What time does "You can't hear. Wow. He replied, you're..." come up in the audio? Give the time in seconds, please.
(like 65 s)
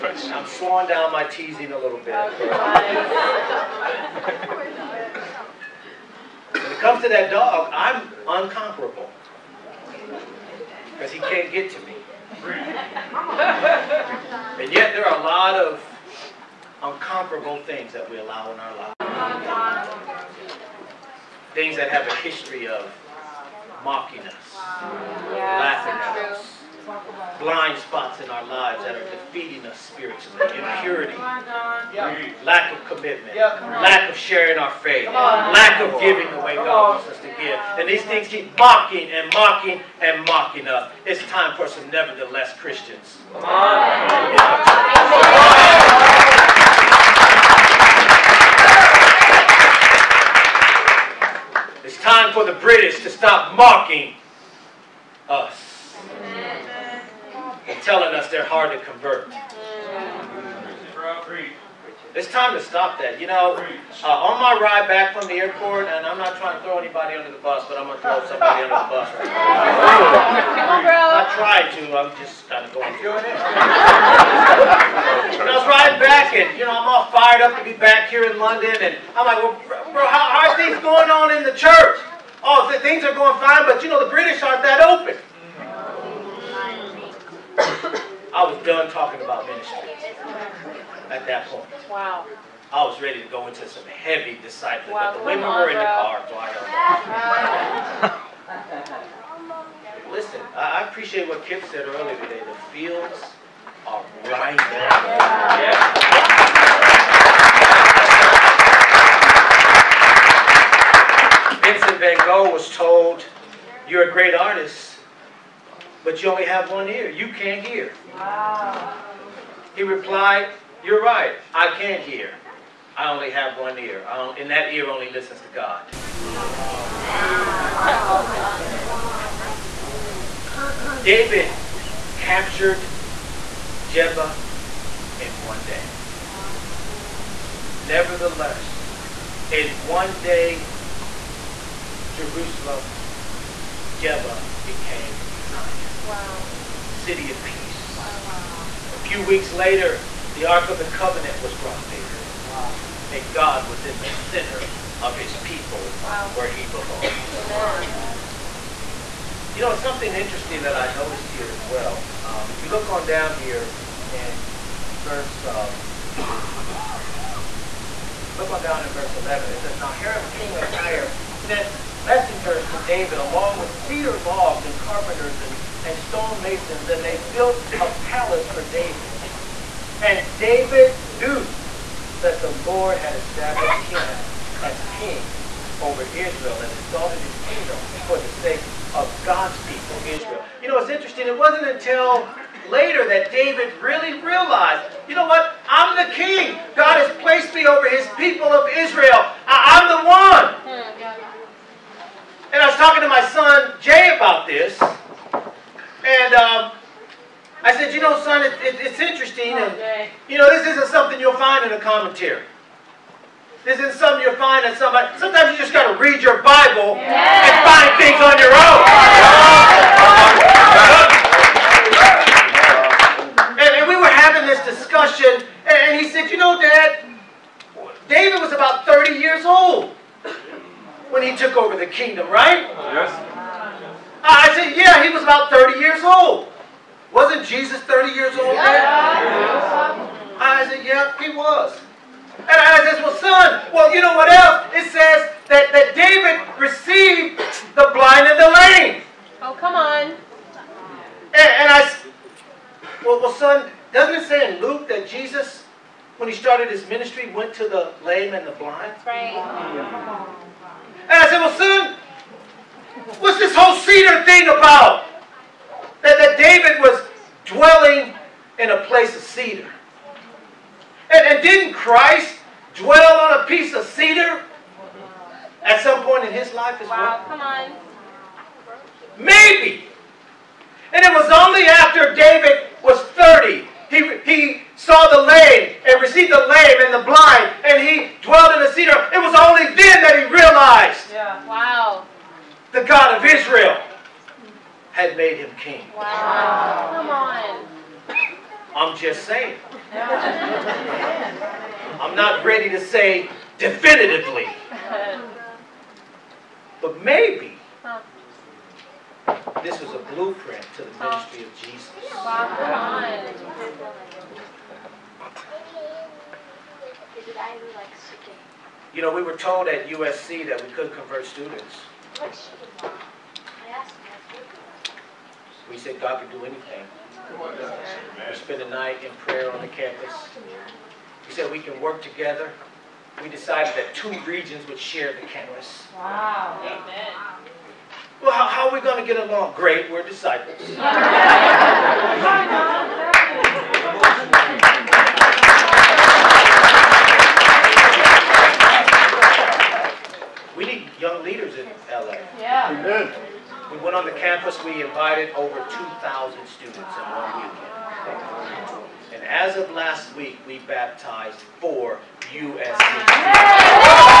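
117 s.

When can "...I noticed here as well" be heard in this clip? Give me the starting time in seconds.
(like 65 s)
160 s.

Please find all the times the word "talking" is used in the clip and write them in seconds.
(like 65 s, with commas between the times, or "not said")
88 s, 202 s.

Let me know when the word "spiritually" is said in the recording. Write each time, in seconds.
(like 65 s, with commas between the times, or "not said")
29 s.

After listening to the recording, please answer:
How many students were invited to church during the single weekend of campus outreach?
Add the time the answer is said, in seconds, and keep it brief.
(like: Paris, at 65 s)
over 2,000, at 355 s.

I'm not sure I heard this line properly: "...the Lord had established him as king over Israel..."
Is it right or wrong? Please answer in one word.
right.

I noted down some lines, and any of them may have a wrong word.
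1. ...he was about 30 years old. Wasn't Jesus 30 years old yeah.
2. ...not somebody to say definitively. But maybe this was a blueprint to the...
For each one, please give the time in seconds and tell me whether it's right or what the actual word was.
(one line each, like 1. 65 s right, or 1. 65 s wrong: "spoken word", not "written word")
1. 235 s right
2. 302 s wrong: "ready", not "somebody".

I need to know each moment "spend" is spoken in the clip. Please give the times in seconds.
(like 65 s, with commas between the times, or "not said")
328 s.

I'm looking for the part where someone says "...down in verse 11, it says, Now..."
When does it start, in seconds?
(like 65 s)
168 s.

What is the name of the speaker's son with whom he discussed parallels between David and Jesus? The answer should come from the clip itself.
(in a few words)
Jay.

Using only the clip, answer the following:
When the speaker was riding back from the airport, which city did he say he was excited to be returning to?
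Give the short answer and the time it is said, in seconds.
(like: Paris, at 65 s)
London, at 78 s.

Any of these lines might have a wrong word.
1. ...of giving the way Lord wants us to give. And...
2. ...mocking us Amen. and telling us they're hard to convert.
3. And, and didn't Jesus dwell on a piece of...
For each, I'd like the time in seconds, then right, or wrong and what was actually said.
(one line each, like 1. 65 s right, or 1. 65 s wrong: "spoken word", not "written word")
1. 35 s wrong: "God", not "Lord"
2. 53 s right
3. 271 s wrong: "Christ", not "Jesus".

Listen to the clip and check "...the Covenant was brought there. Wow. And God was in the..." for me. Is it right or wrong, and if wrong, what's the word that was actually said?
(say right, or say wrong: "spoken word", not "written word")
right.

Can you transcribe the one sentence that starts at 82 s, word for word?
oh, the things are going fine, but you know, the British aren't that open.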